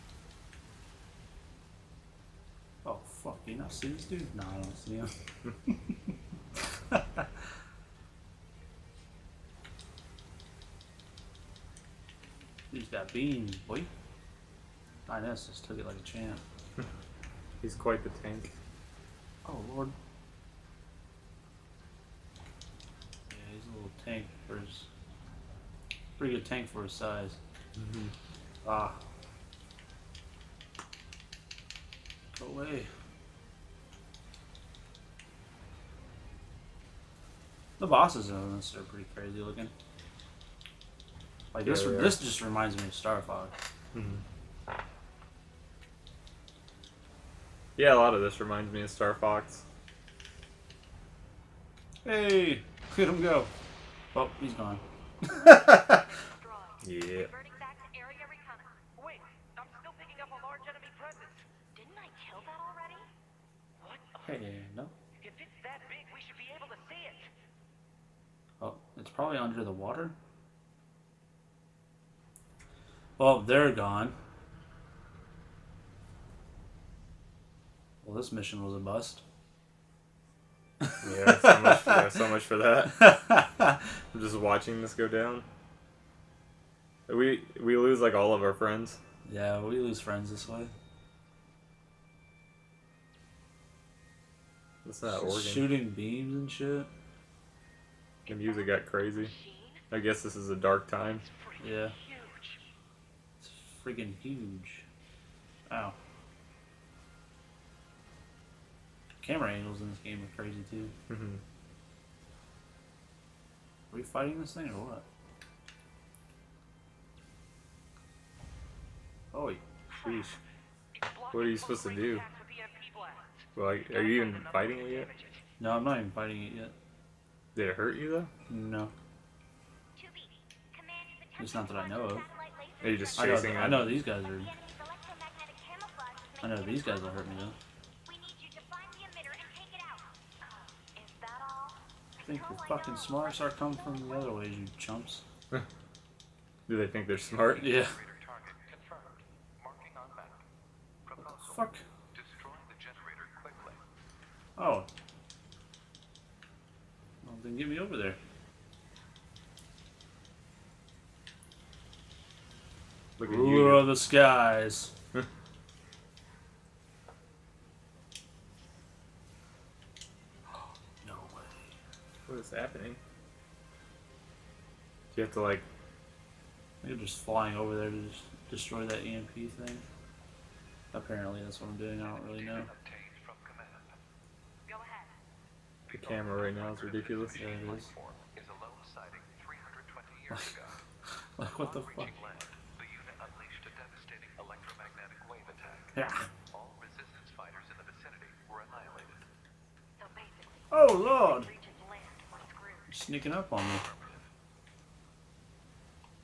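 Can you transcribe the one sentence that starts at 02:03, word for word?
Like, are you even fighting it yet?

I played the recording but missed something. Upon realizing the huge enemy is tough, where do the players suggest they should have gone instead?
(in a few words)
under the water.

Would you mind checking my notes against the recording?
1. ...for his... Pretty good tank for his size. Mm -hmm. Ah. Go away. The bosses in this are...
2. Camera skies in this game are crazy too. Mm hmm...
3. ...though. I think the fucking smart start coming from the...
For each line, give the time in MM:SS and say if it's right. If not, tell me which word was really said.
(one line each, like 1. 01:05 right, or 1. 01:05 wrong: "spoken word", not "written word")
1. 00:24 right
2. 01:49 wrong: "angles", not "skies"
3. 02:17 right.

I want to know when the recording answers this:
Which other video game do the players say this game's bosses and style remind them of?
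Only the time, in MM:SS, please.
00:48.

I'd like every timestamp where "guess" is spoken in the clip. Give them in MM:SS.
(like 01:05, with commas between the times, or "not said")
01:39.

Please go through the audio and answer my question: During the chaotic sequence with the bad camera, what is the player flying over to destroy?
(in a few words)
EMP thing.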